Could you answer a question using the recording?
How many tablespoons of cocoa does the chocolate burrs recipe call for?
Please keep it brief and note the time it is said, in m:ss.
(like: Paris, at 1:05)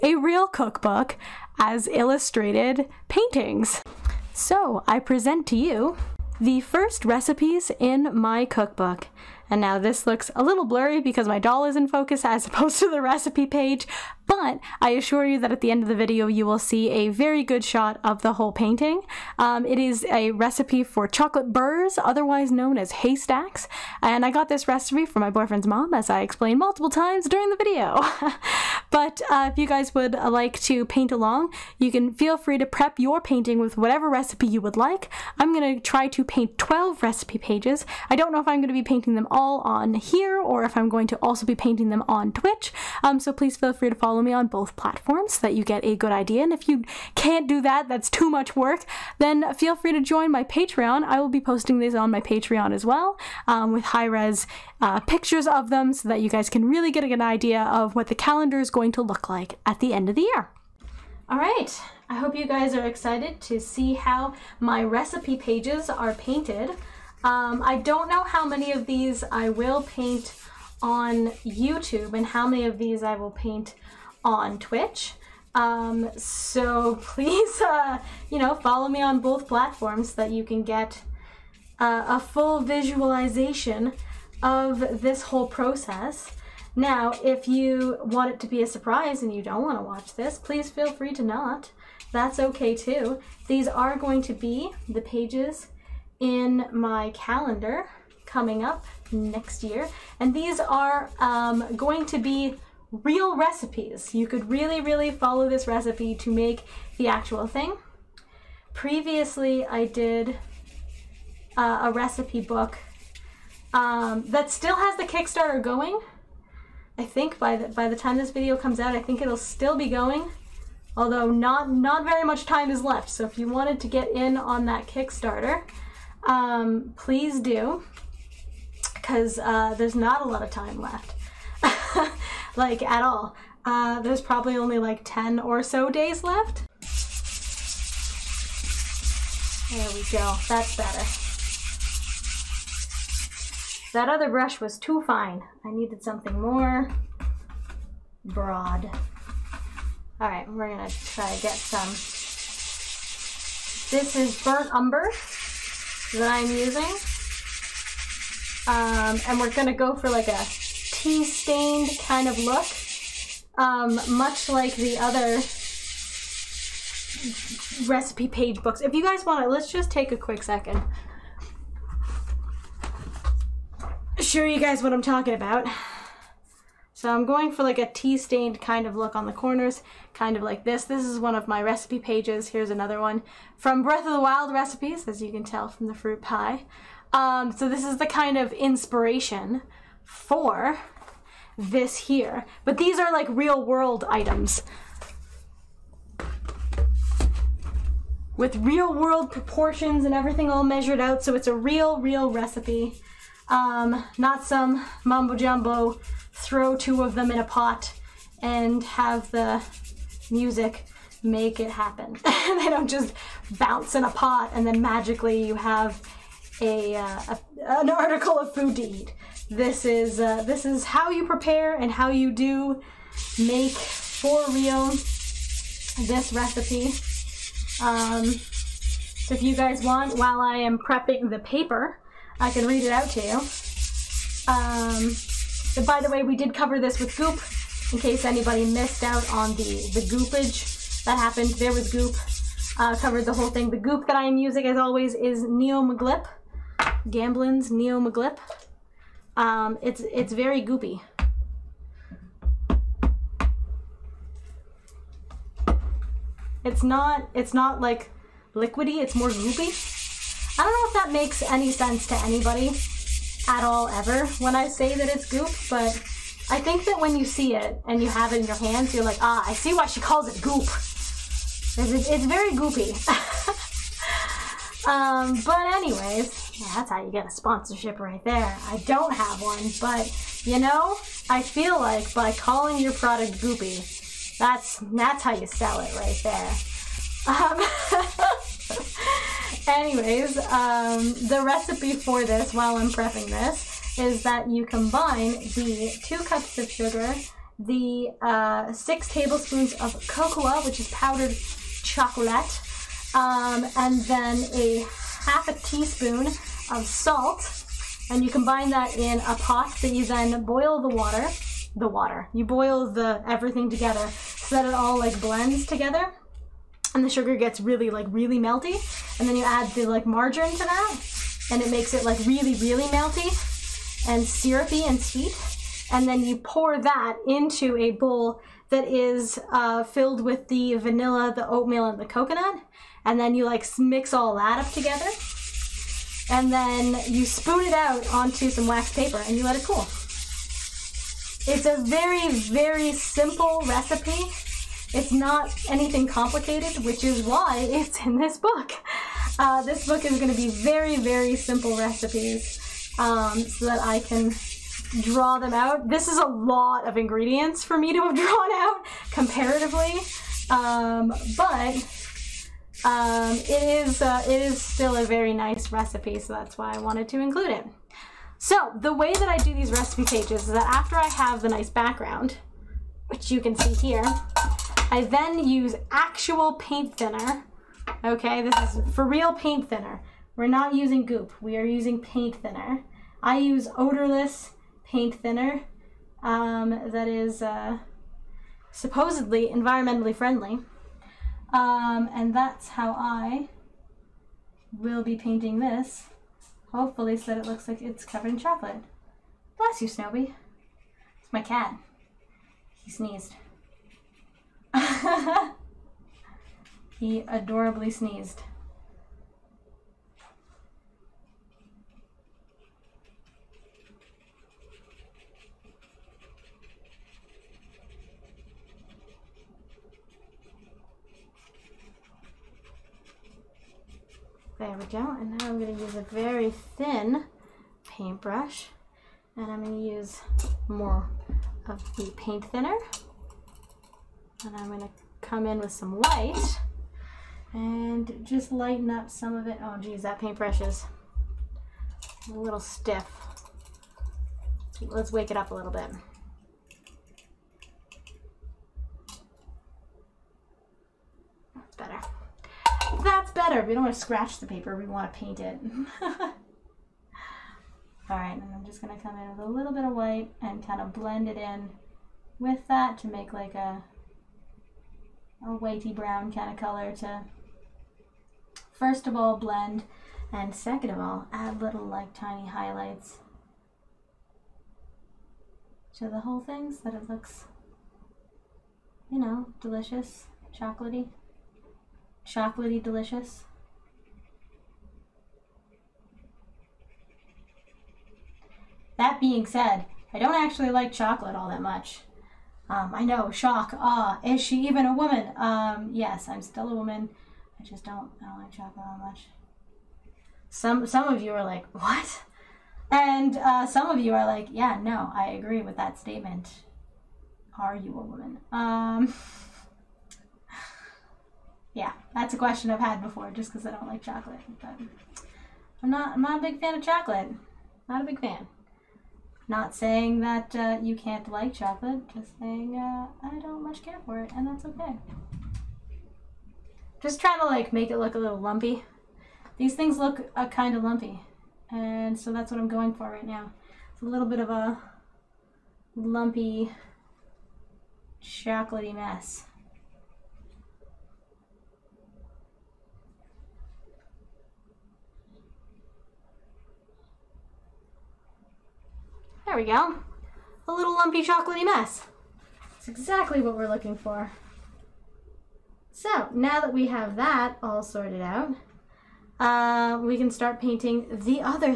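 6, at 4:58.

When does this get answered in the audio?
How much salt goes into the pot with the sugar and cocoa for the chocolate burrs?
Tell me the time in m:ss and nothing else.
5:04.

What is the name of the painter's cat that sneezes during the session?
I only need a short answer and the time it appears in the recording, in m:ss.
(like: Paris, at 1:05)
Snowy, at 6:39.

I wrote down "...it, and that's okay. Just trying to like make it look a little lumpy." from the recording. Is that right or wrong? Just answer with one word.
right.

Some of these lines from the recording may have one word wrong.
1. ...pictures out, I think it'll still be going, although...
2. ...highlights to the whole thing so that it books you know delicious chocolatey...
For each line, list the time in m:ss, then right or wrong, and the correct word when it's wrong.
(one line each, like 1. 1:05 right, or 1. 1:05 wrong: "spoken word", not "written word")
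1. 1:58 wrong: "comes", not "pictures"
2. 7:52 wrong: "looks", not "books".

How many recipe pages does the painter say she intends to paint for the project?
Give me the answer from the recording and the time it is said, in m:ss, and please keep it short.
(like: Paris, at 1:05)
12, at 0:36.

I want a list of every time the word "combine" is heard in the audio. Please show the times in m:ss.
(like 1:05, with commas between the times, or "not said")
4:54, 5:08.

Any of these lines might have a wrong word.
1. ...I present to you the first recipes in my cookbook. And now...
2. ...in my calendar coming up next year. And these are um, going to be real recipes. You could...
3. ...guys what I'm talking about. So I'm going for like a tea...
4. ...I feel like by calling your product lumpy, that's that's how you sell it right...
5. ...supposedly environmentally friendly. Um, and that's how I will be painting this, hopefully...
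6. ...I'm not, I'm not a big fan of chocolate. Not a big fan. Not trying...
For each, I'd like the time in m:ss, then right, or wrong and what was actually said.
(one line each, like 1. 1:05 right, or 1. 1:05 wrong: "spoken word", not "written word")
1. 0:04 right
2. 1:36 right
3. 2:54 right
4. 4:41 wrong: "goopy", not "lumpy"
5. 6:28 right
6. 8:35 wrong: "saying", not "trying".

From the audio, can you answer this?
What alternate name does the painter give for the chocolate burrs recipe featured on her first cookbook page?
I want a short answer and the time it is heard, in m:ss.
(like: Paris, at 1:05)
haystacks, at 0:22.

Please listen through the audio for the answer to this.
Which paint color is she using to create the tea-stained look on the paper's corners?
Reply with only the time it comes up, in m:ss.
2:34.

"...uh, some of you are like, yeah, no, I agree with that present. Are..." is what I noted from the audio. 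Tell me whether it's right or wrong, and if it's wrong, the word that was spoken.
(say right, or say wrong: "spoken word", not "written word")
wrong: "statement", not "present".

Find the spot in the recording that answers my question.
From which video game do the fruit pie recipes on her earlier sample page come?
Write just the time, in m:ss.
3:03.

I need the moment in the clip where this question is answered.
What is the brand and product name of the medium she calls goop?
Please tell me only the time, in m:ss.
4:07.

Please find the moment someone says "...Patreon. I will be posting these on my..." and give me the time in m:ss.
0:50.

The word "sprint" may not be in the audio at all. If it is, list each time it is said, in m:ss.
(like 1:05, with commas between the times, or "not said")
not said.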